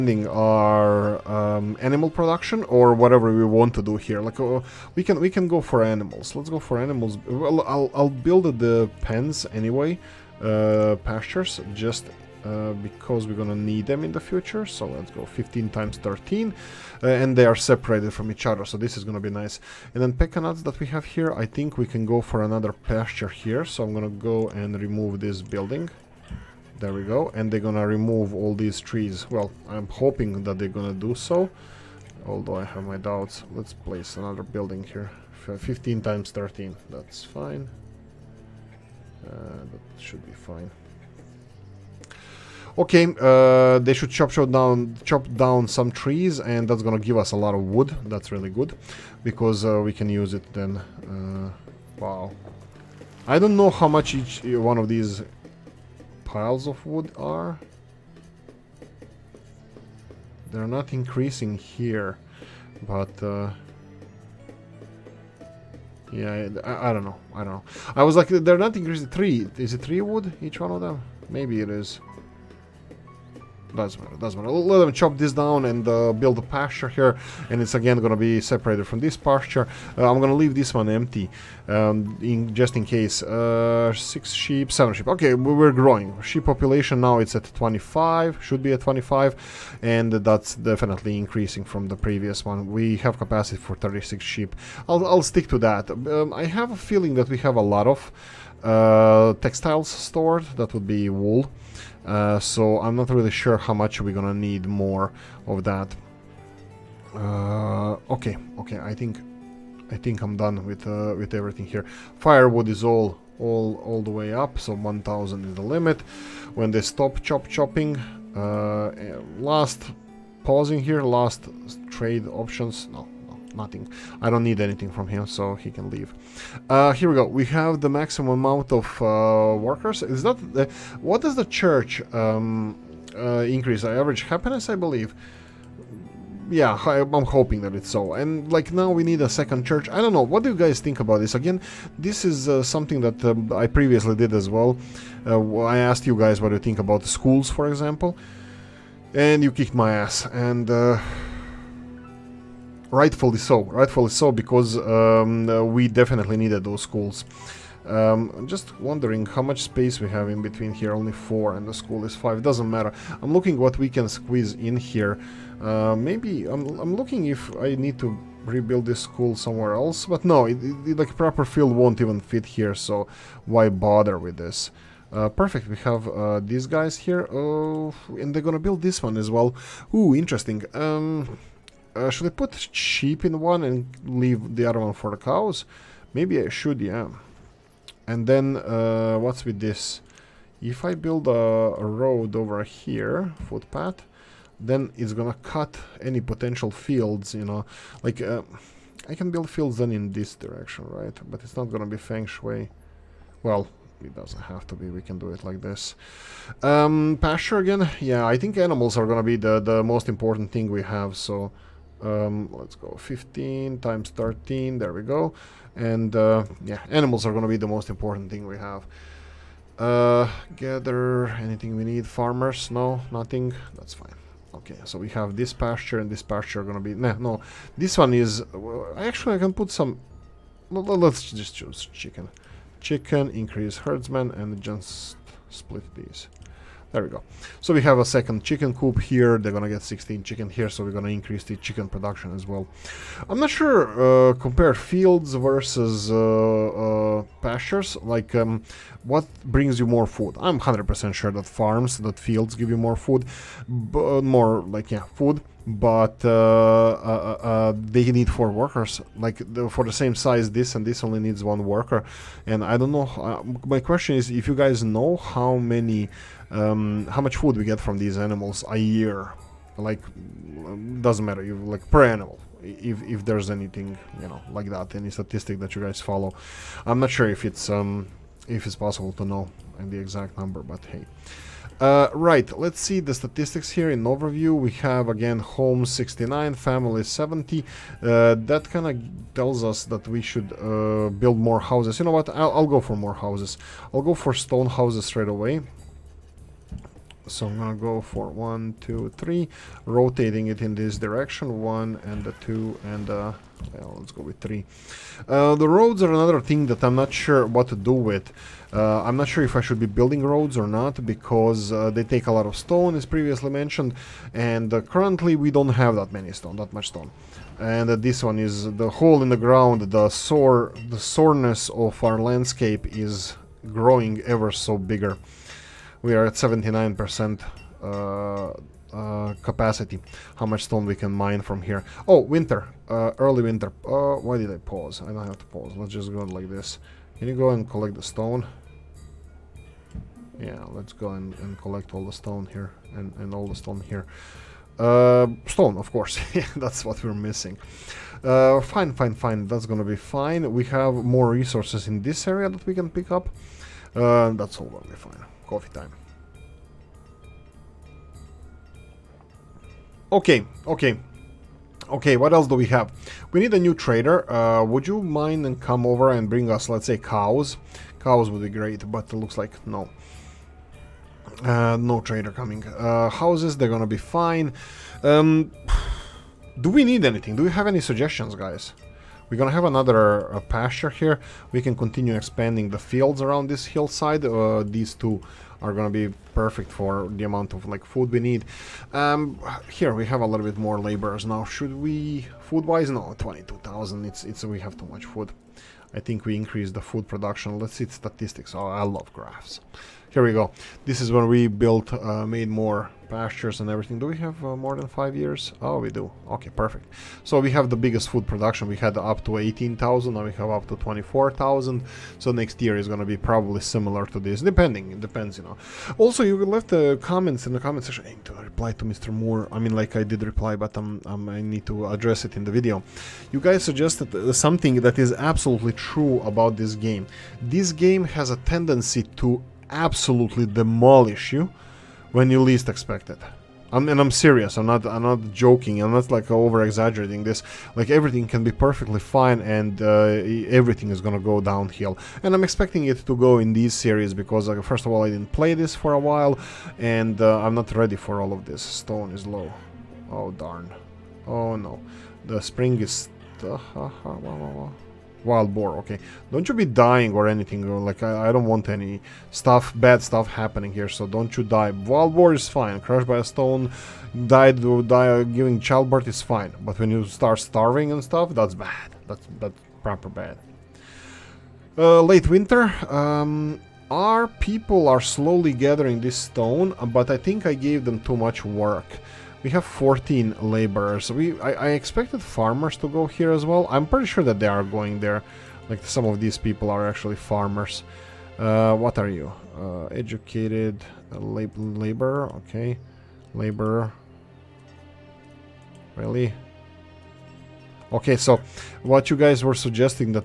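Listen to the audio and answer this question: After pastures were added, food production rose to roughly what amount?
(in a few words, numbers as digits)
24,000.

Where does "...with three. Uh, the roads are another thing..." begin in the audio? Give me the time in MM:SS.
05:04.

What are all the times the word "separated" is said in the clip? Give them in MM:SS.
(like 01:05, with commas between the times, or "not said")
00:17, 01:18.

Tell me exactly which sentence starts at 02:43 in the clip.
I'm looking what we can squeeze in here.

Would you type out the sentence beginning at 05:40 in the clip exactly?
Yeah, let's go and, and collect all the stone here.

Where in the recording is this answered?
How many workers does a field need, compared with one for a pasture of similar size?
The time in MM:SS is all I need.
04:18.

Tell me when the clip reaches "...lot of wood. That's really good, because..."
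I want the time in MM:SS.
00:47.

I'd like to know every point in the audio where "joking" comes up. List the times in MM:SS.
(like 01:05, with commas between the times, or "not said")
07:15.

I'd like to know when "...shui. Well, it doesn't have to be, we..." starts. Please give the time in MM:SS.
03:22.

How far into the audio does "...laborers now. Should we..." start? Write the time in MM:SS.
06:30.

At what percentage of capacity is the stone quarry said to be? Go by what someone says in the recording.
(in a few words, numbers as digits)
79%.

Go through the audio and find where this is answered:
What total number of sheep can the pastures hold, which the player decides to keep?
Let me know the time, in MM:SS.
01:33.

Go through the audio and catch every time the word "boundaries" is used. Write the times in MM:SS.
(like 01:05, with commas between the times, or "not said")
not said.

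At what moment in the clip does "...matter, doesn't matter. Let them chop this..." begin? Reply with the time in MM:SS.
01:14.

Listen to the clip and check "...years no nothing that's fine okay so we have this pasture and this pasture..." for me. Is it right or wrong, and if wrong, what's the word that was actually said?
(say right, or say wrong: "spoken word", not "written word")
wrong: "farmers", not "years".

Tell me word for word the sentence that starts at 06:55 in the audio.
Also, you left the comments in the comment section.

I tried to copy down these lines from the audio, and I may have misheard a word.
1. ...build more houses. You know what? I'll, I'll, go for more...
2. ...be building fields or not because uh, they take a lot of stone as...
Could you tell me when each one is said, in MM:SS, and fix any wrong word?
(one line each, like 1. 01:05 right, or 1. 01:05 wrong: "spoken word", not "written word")
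1. 04:51 right
2. 05:09 wrong: "roads", not "fields".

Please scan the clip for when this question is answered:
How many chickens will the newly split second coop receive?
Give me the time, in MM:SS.
03:59.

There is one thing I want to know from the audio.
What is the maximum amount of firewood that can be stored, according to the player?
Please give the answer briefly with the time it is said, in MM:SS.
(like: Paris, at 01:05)
1,000, at 01:54.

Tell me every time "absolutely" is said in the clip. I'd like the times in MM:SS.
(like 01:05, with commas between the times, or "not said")
07:05, 07:09.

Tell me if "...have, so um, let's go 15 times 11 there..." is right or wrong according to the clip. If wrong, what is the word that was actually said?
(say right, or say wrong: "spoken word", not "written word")
wrong: "13", not "11".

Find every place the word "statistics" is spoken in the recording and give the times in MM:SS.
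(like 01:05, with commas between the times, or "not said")
04:35, 04:43, 06:37.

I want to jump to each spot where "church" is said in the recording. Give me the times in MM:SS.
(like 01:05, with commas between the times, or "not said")
02:11, 02:19.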